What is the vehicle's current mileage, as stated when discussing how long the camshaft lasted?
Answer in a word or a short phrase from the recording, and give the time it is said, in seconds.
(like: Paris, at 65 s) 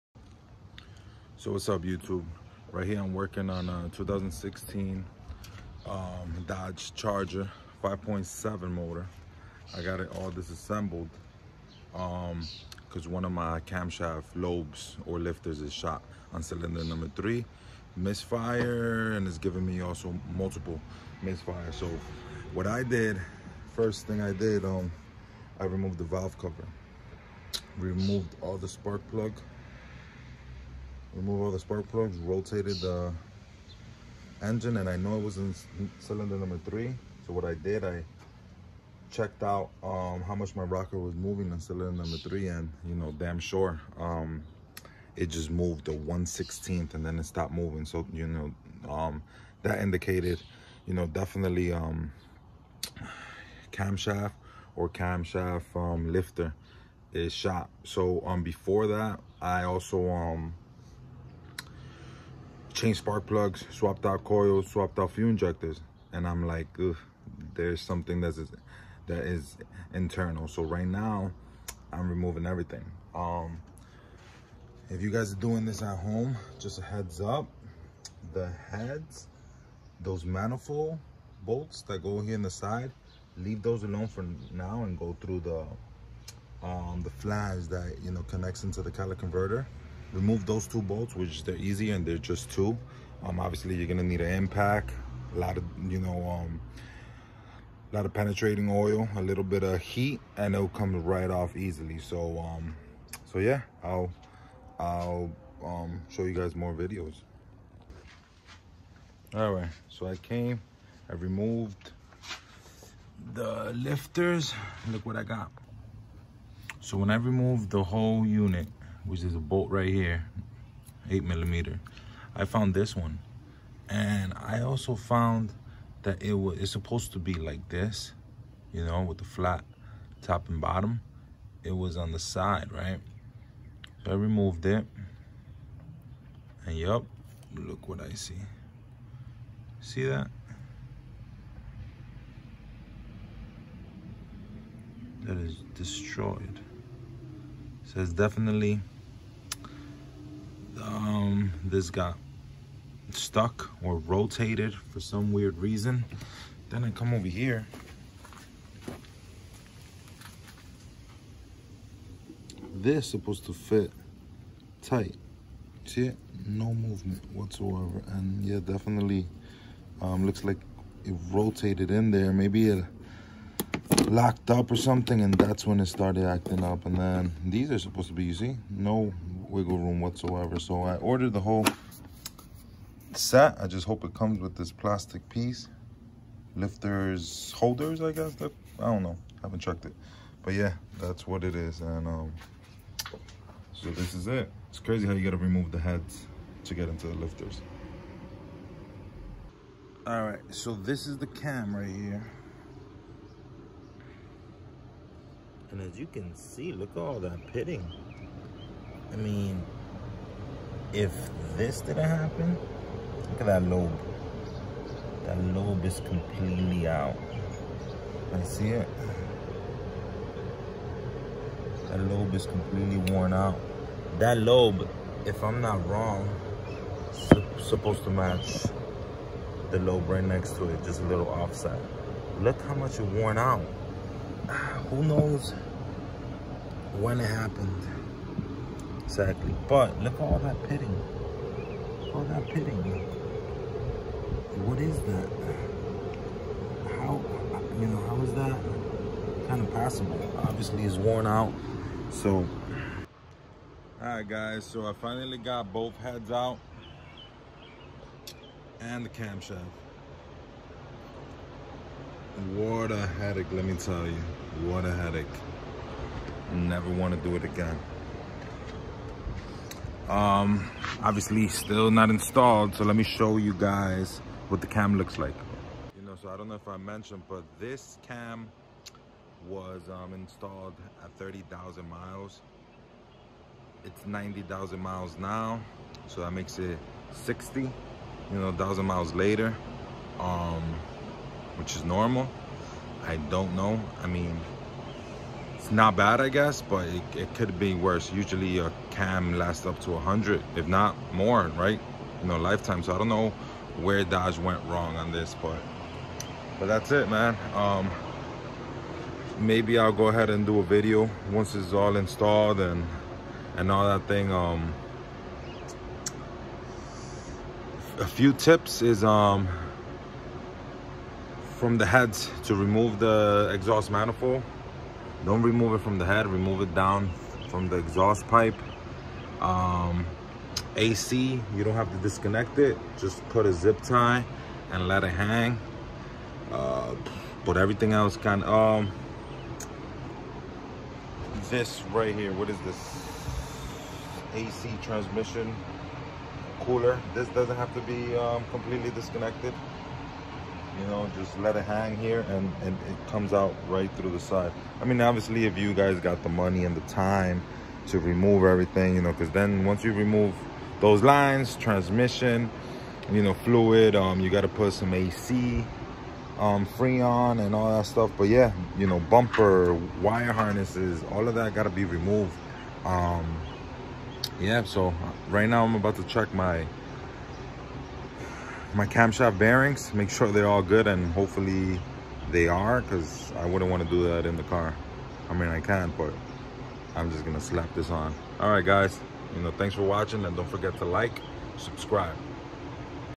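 90,000 miles, at 284 s.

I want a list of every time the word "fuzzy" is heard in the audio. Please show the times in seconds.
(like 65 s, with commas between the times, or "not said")
not said.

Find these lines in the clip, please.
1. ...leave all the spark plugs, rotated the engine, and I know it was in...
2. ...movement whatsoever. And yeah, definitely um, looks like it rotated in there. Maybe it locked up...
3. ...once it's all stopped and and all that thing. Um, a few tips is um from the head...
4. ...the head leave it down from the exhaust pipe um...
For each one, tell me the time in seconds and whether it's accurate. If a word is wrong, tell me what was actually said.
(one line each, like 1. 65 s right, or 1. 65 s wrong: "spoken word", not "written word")
1. 31 s wrong: "remove", not "leave"
2. 166 s right
3. 311 s wrong: "installed", not "stopped"
4. 325 s wrong: "remove", not "leave".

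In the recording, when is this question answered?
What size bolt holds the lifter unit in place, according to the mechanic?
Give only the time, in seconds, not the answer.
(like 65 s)
121 s.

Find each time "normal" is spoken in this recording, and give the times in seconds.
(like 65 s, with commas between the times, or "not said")
291 s.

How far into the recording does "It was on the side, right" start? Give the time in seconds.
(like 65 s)
131 s.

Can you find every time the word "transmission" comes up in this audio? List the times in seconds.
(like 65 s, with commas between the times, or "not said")
344 s, 361 s.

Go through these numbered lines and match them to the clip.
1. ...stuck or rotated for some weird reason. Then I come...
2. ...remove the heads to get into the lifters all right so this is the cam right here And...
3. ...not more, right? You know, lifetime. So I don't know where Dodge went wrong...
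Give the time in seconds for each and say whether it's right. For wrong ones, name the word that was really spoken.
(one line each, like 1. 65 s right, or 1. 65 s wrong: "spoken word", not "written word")
1. 153 s right
2. 195 s right
3. 300 s right.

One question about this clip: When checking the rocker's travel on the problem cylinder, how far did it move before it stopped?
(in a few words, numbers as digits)
1/16.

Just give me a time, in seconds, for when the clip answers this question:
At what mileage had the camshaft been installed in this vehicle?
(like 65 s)
281 s.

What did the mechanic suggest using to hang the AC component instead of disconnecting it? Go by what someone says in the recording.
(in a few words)
zip tie.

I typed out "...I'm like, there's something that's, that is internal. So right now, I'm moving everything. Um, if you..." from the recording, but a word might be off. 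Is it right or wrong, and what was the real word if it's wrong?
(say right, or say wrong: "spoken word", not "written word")
wrong: "removing", not "moving".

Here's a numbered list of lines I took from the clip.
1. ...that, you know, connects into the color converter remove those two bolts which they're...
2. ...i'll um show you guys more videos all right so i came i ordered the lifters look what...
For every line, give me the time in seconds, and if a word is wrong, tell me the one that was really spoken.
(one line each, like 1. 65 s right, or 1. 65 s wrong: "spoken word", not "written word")
1. 87 s right
2. 104 s wrong: "removed", not "ordered".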